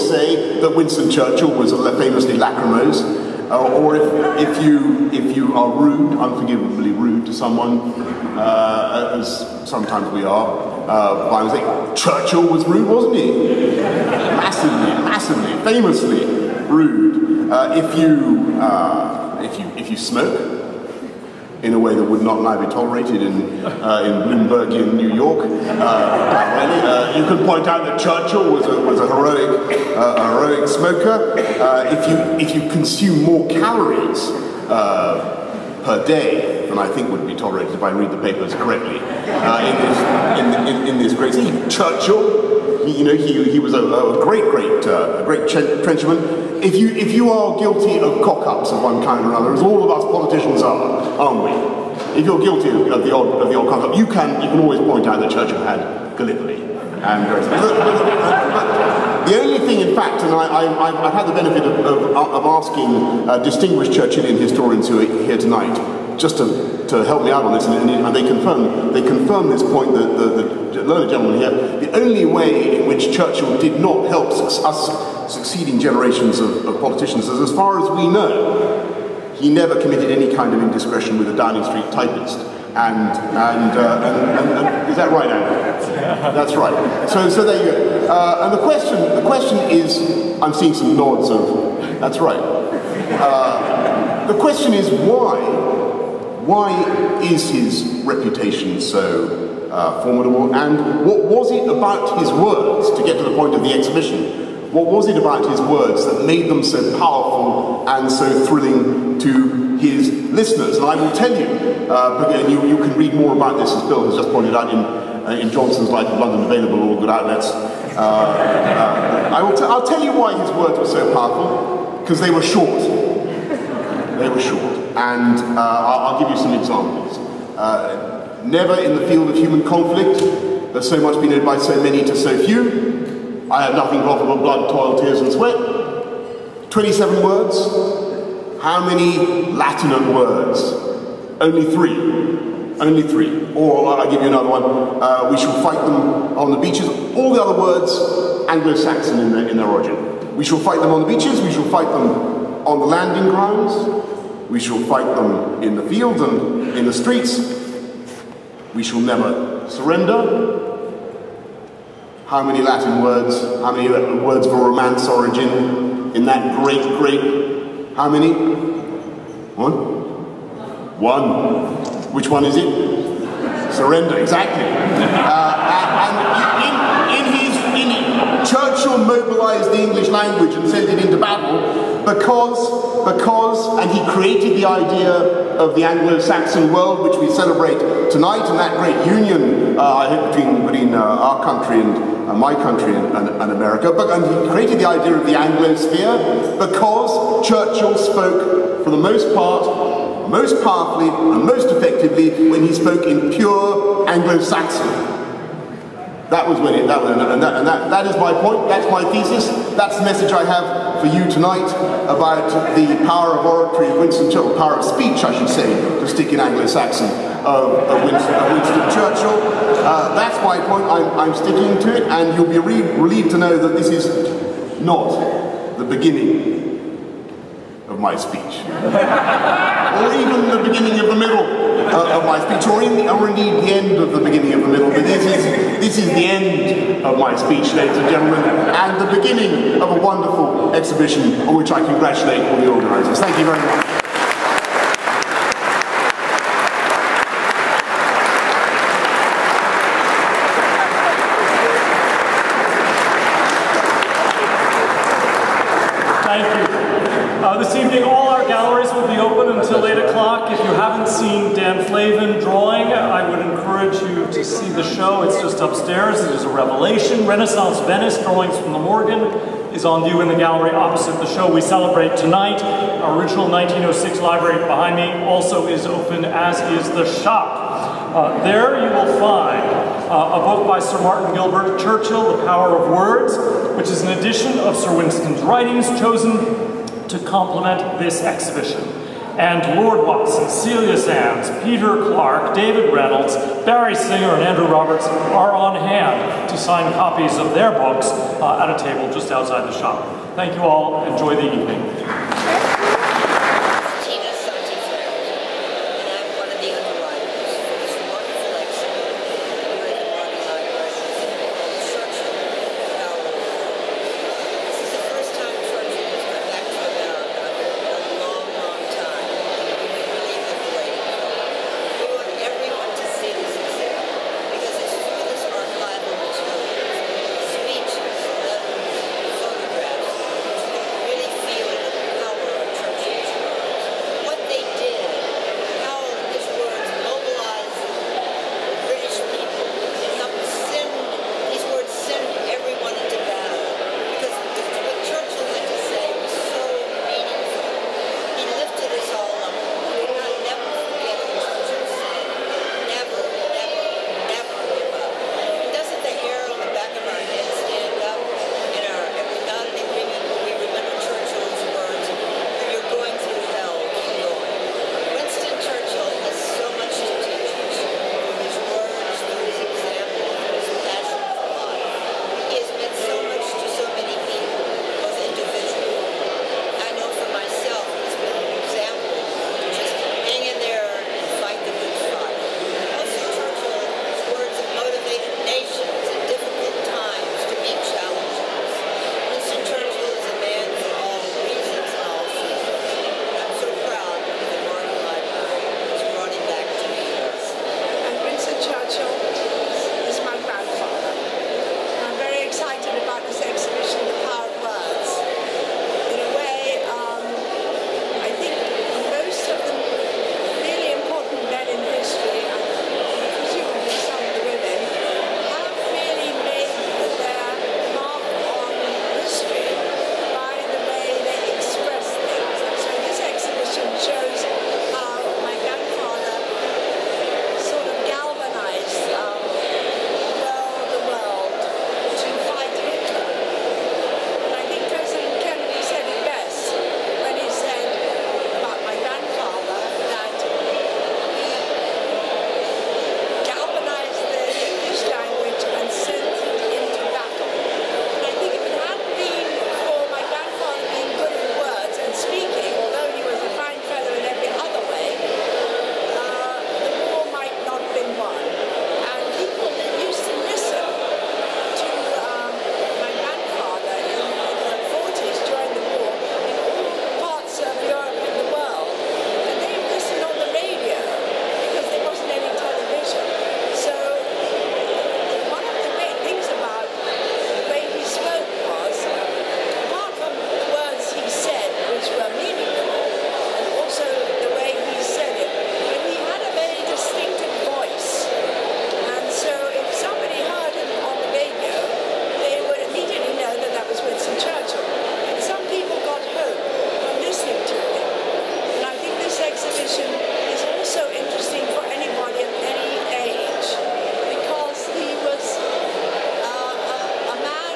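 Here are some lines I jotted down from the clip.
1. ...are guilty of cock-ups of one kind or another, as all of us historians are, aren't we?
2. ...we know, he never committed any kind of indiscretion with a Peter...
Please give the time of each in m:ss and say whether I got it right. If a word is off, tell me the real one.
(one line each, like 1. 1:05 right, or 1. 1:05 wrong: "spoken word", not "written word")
1. 0:47 wrong: "politicians", not "historians"
2. 1:17 wrong: "Downing", not "Peter".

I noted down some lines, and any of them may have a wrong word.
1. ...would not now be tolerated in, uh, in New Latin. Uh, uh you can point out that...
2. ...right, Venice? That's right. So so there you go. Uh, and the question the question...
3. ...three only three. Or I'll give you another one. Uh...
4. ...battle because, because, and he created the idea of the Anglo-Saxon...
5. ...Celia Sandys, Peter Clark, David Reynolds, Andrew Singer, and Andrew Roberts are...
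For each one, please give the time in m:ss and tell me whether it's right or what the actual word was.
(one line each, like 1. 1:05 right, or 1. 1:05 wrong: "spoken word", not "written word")
1. 0:22 wrong: "York", not "Latin"
2. 1:25 wrong: "Andrew", not "Venice"
3. 2:21 right
4. 3:01 right
5. 4:50 wrong: "Barry", not "Andrew".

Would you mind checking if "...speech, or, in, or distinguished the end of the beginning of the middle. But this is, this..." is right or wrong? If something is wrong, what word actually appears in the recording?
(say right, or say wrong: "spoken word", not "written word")
wrong: "indeed", not "distinguished".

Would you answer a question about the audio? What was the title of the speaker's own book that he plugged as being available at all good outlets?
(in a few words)
Johnson's Life in London.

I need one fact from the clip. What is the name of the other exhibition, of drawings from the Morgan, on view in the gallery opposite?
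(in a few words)
Renaissance Venice.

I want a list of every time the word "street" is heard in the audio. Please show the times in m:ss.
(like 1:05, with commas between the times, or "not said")
1:21, 2:36.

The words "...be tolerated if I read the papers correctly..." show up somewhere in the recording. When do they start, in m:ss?
0:37.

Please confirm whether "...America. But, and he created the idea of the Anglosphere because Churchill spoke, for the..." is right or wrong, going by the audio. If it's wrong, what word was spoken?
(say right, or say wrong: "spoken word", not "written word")
right.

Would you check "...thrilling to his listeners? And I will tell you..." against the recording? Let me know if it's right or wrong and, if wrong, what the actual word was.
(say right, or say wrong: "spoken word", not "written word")
right.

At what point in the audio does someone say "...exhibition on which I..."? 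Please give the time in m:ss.
4:00.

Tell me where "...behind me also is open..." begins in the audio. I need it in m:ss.
4:34.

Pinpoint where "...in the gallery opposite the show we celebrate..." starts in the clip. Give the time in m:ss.
4:30.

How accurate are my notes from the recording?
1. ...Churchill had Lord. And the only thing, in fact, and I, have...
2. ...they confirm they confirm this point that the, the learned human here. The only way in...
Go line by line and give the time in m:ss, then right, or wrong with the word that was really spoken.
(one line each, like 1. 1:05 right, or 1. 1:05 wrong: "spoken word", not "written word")
1. 0:55 wrong: "Gallipoli", not "Lord"
2. 1:08 wrong: "gentleman", not "human".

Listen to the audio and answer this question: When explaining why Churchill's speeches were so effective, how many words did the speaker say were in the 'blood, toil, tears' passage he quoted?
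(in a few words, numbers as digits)
27.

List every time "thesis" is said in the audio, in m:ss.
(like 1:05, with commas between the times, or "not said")
3:29.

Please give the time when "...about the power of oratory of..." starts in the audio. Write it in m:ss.
3:32.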